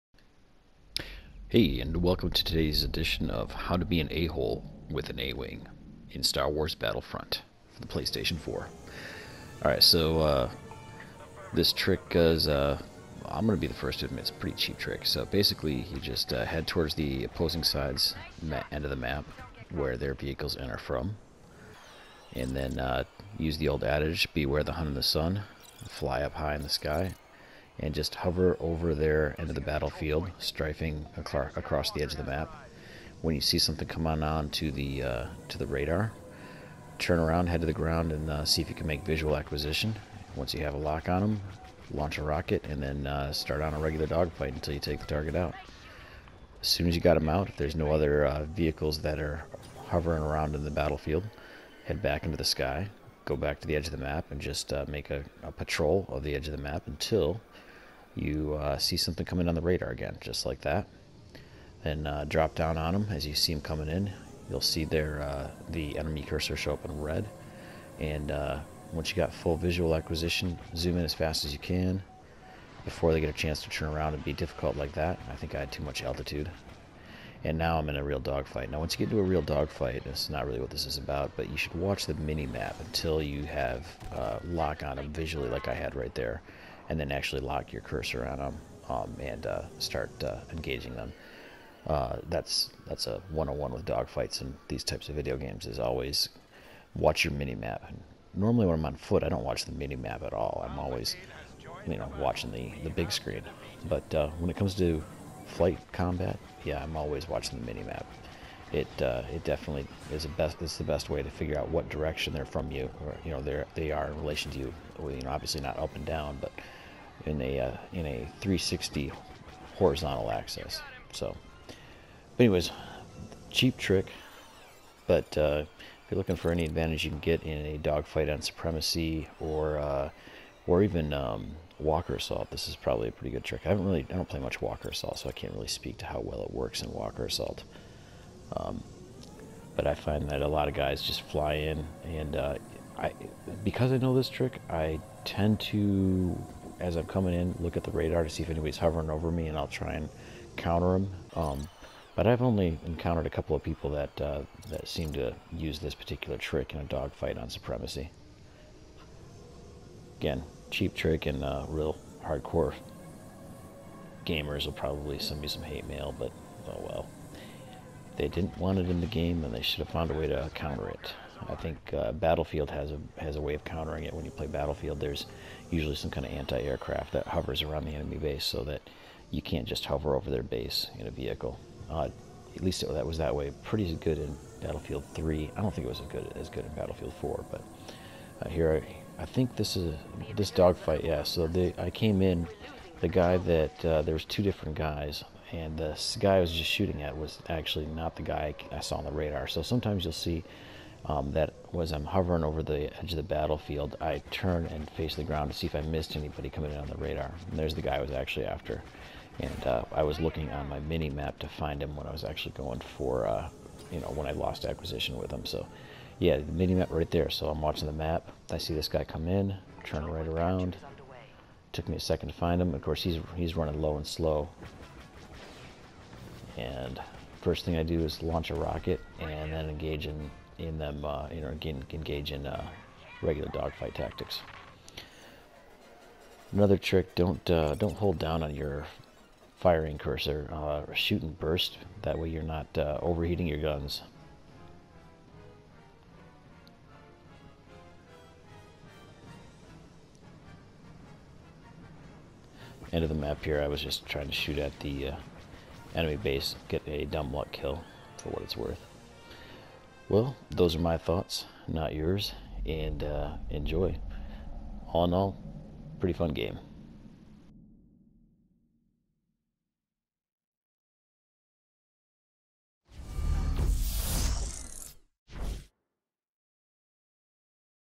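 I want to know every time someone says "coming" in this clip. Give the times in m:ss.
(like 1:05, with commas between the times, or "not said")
0:59, 1:03, 2:27, 3:26.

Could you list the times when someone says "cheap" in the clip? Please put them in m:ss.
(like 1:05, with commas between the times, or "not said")
0:14, 2:03, 2:40.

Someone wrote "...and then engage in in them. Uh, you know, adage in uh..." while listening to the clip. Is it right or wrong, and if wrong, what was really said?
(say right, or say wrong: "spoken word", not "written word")
wrong: "engage", not "adage".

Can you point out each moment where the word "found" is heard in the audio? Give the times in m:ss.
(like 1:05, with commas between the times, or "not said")
2:49.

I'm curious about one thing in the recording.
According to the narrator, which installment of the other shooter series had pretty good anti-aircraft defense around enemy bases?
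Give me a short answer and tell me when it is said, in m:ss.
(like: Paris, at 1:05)
Battlefield 3, at 3:04.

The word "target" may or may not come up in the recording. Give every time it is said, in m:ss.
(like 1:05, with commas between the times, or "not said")
0:45.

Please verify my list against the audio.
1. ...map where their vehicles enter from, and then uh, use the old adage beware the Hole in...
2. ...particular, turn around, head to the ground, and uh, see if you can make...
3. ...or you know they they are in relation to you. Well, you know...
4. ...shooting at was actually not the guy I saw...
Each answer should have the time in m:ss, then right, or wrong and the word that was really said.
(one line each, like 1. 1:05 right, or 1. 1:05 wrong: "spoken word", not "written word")
1. 0:18 wrong: "Hun", not "Hole"
2. 0:35 wrong: "radar", not "particular"
3. 1:53 right
4. 3:16 right.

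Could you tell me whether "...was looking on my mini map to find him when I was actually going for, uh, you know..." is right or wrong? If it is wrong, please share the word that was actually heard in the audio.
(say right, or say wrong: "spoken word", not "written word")
right.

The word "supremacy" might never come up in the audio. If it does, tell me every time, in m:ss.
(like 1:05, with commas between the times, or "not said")
2:08, 2:37.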